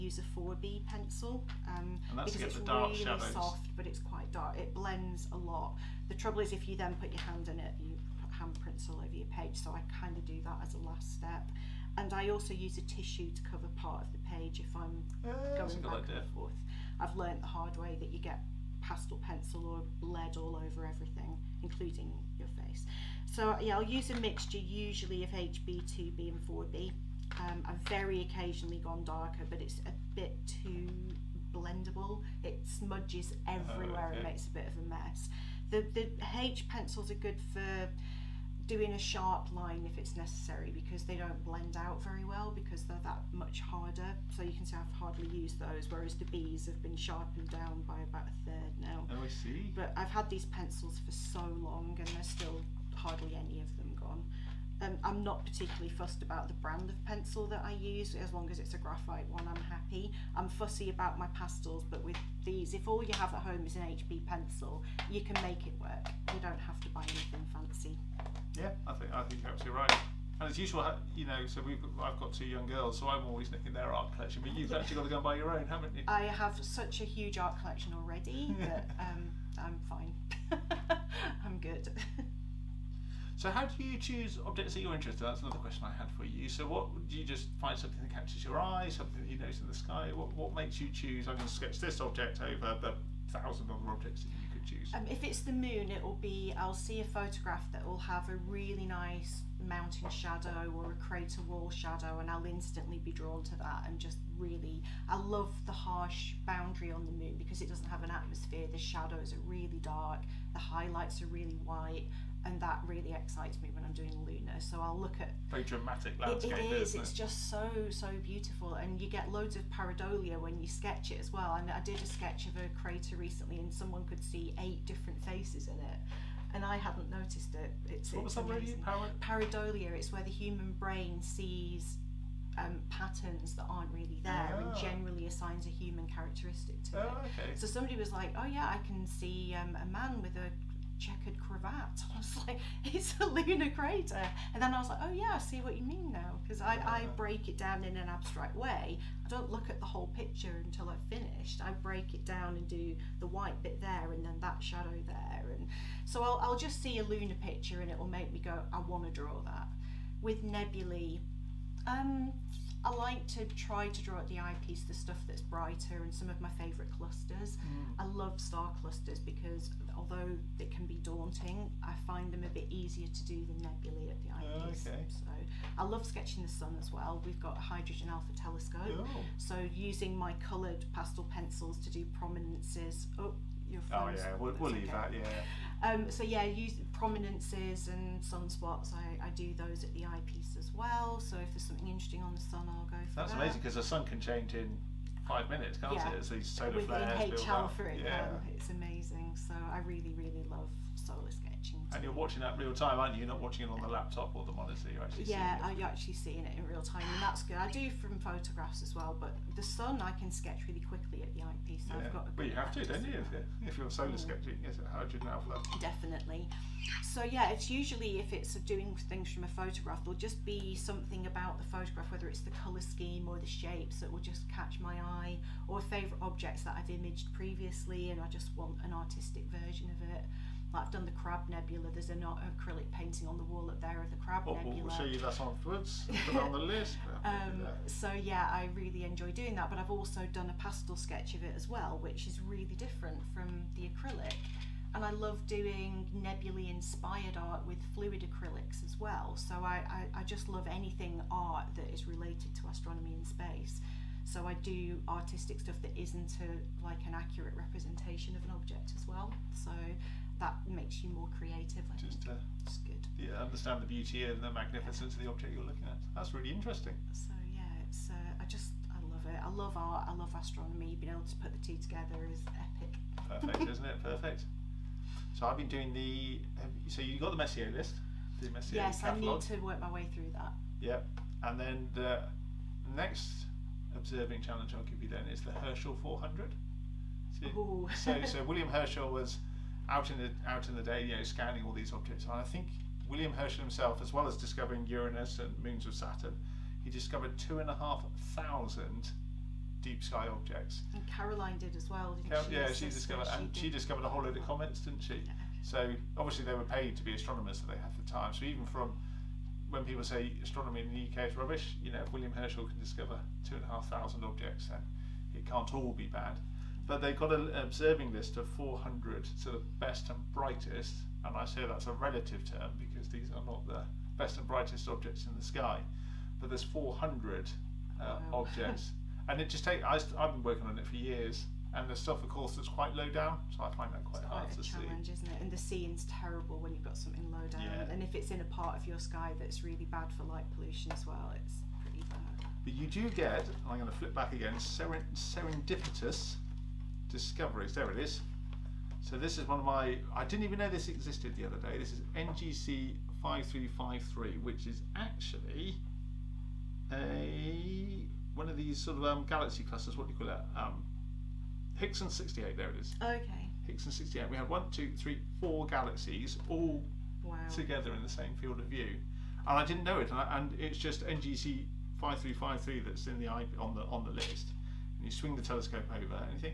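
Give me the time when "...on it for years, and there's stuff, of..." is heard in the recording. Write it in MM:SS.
05:30.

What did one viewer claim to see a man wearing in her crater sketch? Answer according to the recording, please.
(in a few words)
A checkered cravat.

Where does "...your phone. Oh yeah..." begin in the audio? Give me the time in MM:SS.
03:03.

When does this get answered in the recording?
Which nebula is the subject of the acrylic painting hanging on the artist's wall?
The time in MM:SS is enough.
03:51.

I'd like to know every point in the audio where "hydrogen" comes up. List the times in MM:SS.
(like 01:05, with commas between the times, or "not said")
02:57, 03:34.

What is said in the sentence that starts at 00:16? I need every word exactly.
I've learnt the hard way that you get pastel pencil or lead all over everything, including your face.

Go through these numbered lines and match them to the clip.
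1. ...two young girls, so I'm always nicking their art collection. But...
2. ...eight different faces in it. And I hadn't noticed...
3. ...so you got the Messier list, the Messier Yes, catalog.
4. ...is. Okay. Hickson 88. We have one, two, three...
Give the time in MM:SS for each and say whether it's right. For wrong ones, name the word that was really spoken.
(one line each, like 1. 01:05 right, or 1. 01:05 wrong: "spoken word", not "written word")
1. 01:12 right
2. 02:04 right
3. 04:36 right
4. 06:02 wrong: "68", not "88".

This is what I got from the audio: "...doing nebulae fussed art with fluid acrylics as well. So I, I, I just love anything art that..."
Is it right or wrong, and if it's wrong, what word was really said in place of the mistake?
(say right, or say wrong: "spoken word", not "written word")
wrong: "inspired", not "fussed".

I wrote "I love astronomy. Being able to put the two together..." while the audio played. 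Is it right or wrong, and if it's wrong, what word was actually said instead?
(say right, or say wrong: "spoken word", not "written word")
right.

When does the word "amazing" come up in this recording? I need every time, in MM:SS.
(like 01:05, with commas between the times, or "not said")
03:13, 03:18.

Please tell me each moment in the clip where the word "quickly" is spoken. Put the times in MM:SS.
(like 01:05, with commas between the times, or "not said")
03:30.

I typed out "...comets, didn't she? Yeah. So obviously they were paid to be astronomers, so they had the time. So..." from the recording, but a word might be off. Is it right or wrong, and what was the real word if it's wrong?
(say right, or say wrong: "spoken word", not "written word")
right.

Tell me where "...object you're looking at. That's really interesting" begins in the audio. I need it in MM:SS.
04:25.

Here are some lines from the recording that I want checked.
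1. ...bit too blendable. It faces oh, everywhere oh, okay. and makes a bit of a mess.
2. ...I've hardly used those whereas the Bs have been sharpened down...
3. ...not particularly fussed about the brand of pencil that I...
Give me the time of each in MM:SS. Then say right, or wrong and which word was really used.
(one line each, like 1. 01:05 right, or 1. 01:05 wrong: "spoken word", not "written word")
1. 00:30 wrong: "smudges", not "faces"
2. 00:44 right
3. 00:55 right.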